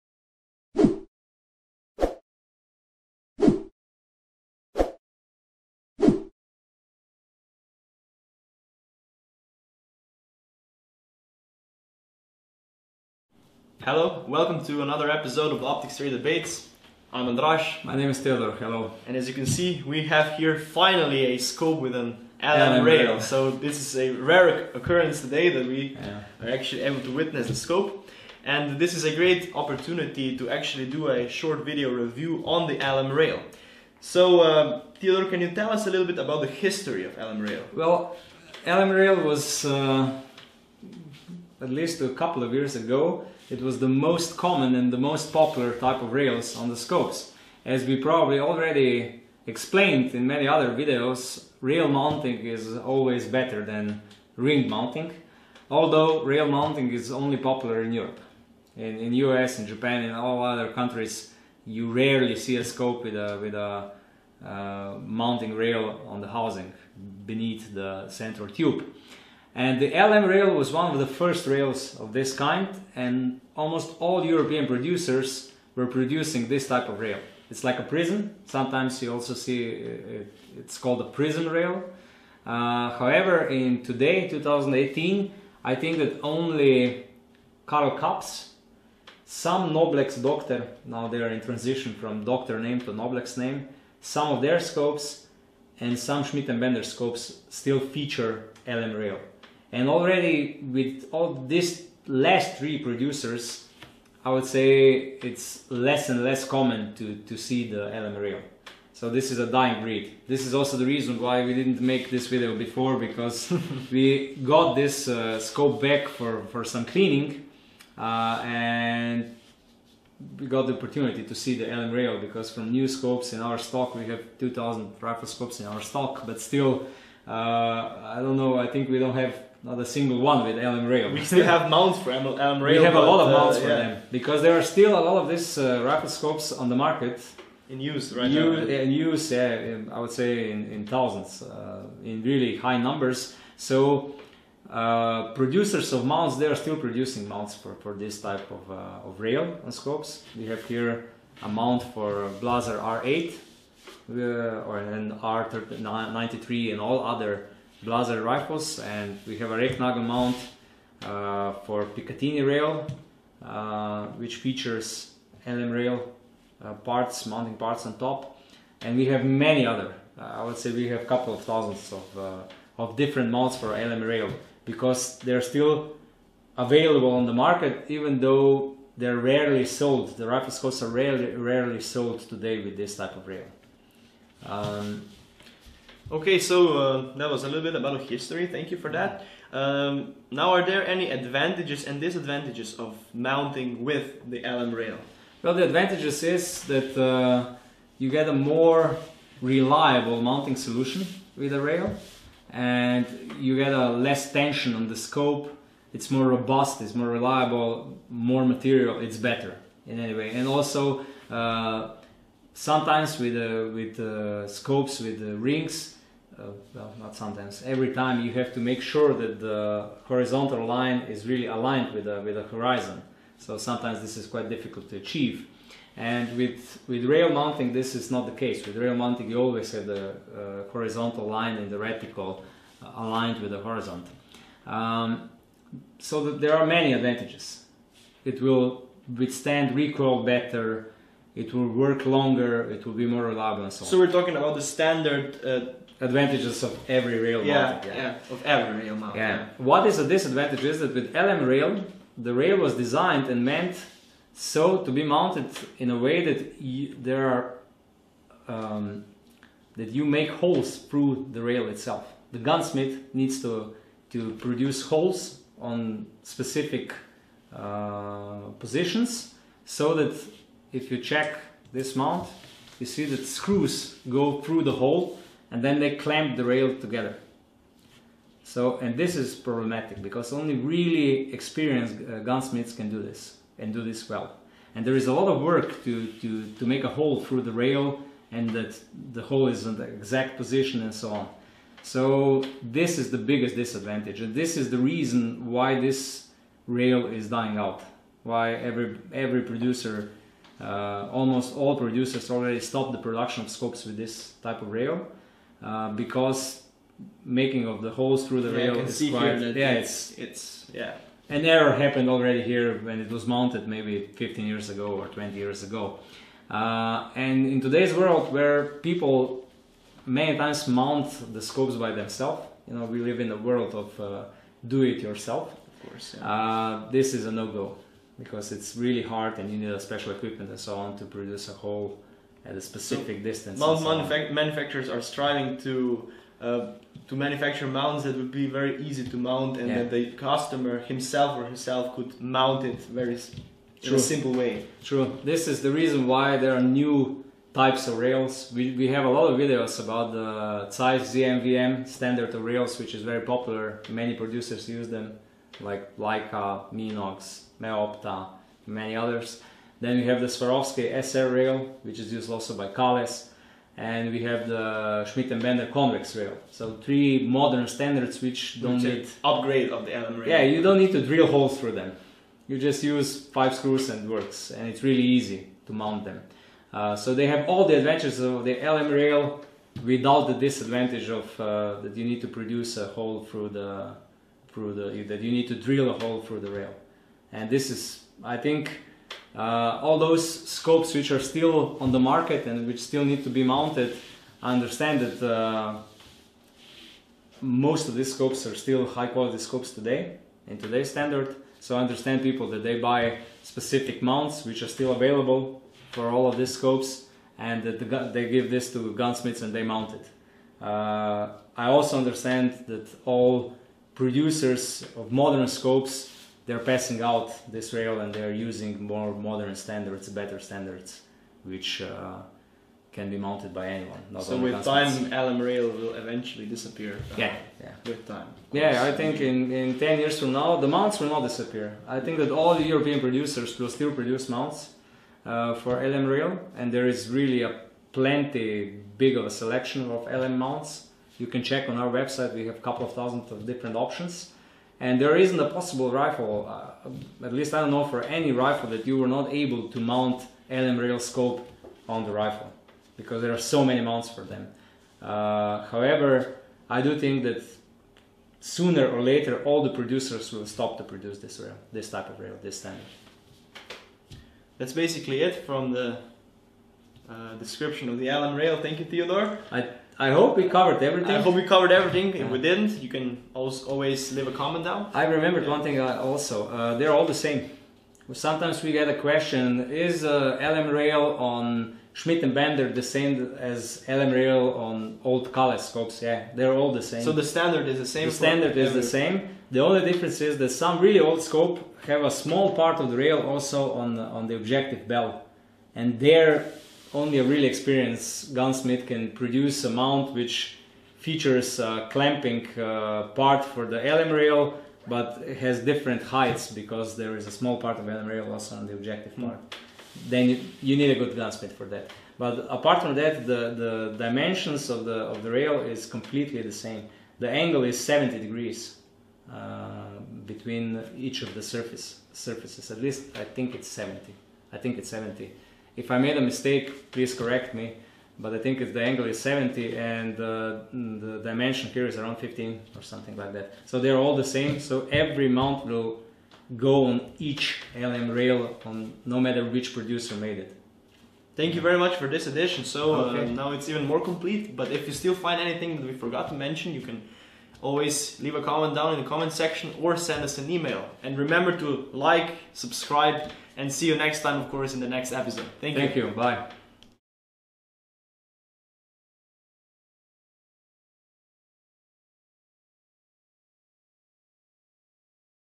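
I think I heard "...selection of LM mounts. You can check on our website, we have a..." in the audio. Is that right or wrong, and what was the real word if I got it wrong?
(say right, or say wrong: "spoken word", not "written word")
right.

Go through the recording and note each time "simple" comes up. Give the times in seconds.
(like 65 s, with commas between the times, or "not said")
343 s.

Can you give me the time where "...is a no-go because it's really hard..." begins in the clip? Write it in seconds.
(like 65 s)
327 s.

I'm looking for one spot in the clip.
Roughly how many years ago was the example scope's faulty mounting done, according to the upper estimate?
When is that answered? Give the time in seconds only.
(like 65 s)
315 s.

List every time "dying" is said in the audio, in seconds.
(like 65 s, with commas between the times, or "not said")
109 s, 297 s.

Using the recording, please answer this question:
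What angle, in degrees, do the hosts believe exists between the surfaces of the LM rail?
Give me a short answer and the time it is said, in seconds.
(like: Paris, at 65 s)
70, at 517 s.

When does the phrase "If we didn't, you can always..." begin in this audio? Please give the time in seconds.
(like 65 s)
472 s.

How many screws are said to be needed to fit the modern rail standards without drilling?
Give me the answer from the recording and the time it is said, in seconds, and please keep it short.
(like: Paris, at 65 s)
5, at 373 s.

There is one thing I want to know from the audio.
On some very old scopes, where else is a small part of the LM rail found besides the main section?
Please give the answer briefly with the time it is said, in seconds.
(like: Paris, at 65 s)
objective bell, at 494 s.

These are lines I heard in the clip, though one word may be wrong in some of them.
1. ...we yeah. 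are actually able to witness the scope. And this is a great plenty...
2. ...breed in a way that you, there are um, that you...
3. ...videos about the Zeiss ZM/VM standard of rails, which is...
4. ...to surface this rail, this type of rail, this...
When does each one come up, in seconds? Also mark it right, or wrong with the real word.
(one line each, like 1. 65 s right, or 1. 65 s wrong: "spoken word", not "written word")
1. 25 s wrong: "opportunity", not "plenty"
2. 255 s wrong: "mounted", not "breed"
3. 349 s right
4. 460 s wrong: "produce", not "surface".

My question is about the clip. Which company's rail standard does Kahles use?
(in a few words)
Swarovski.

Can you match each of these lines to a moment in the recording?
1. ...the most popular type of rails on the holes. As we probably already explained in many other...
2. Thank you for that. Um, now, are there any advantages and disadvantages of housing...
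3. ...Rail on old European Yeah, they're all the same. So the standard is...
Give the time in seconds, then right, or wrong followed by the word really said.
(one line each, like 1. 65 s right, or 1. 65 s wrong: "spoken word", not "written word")
1. 44 s wrong: "scopes", not "holes"
2. 188 s wrong: "mounting", not "housing"
3. 484 s wrong: "Kale", not "European".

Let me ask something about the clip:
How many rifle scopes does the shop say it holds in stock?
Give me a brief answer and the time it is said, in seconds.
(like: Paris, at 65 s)
2000, at 124 s.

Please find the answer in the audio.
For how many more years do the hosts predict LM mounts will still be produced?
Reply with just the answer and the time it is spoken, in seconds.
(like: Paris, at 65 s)
10, at 429 s.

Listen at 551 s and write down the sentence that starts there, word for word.
And remember to like, subscribe, and see you next time, of course, in the next episode.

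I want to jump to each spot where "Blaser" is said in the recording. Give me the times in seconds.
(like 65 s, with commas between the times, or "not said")
152 s, 157 s.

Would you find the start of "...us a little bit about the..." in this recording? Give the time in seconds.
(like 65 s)
35 s.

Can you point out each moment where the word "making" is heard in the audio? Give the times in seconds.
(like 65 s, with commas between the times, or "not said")
307 s.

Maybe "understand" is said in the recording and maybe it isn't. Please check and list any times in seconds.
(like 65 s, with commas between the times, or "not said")
394 s, 401 s, 411 s.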